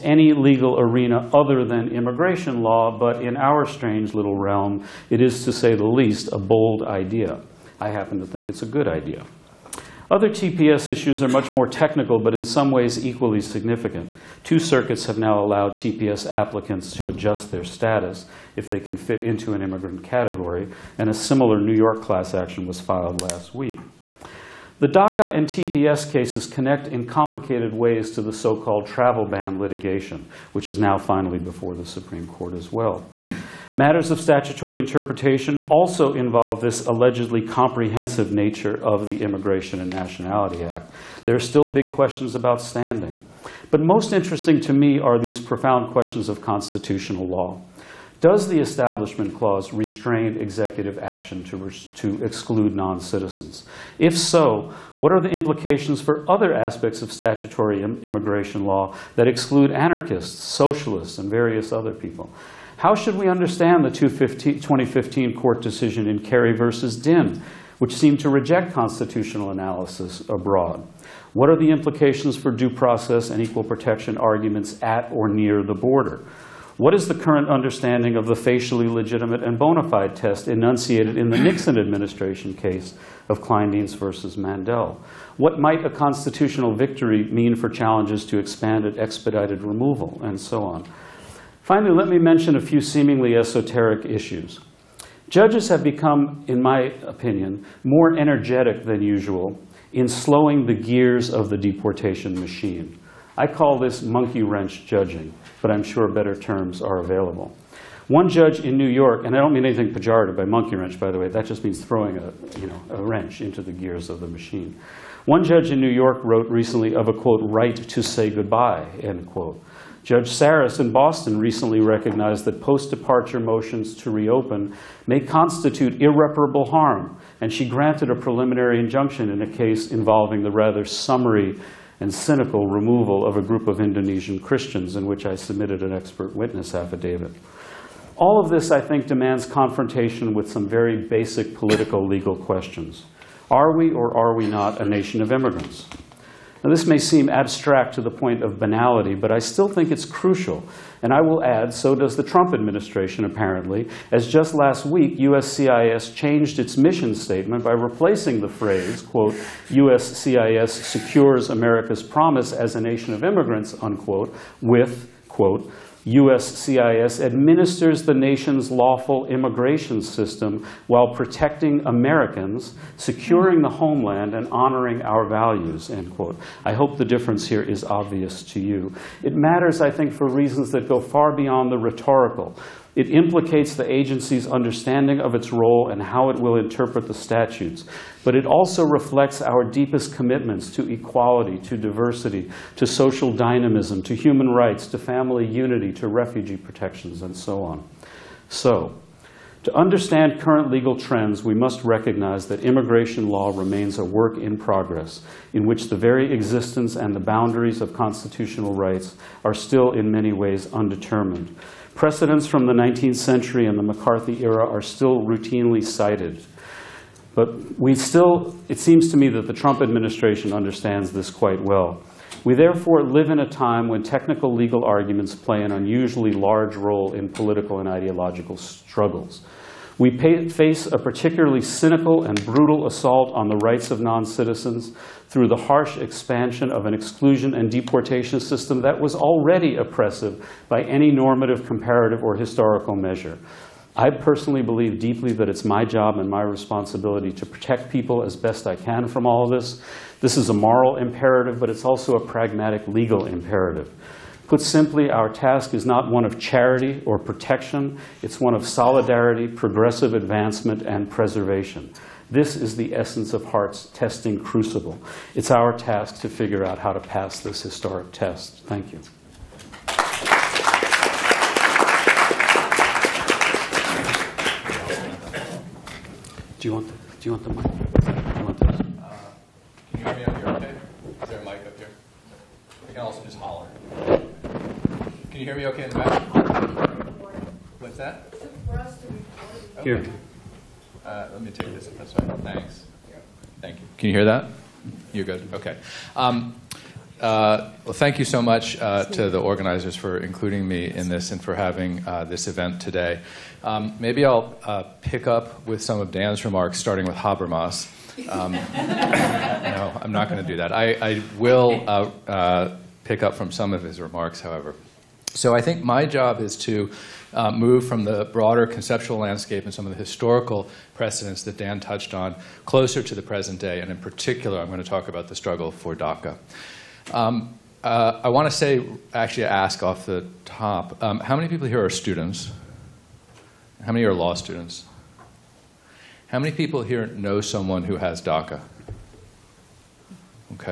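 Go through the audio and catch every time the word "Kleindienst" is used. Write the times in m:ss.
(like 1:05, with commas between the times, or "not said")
1:23.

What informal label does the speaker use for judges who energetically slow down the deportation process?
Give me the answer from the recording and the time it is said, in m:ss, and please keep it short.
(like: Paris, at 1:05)
monkey wrench judging, at 1:44.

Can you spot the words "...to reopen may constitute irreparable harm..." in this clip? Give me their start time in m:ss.
2:03.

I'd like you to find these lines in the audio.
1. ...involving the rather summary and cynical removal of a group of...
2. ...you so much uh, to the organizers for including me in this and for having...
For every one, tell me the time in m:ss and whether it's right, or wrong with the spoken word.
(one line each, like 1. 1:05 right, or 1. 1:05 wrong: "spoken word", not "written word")
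1. 2:09 right
2. 4:58 right.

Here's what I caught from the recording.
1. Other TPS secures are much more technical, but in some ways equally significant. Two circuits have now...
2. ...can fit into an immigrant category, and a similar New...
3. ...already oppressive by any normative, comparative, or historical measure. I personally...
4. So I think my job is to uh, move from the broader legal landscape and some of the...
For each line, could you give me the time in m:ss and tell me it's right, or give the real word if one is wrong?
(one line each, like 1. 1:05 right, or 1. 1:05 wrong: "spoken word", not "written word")
1. 0:10 wrong: "issues", not "secures"
2. 0:18 right
3. 3:59 right
4. 5:15 wrong: "conceptual", not "legal".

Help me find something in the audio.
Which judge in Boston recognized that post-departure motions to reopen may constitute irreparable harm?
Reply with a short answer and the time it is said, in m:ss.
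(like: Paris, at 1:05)
Judge Saris, at 2:00.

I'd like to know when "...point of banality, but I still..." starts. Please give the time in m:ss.
2:28.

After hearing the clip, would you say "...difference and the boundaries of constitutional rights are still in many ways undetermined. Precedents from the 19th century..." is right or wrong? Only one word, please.
wrong.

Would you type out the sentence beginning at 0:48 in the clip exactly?
Does the Establishment Clause restrain executive action to, to exclude non-citizens?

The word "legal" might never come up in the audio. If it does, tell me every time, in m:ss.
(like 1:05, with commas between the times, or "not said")
0:00, 2:22, 3:20, 3:44, 4:12.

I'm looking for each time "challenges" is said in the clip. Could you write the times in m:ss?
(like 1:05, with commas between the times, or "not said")
1:27.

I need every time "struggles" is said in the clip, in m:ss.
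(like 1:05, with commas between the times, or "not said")
3:48, 5:25.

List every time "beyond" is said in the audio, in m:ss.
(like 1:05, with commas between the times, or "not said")
3:01.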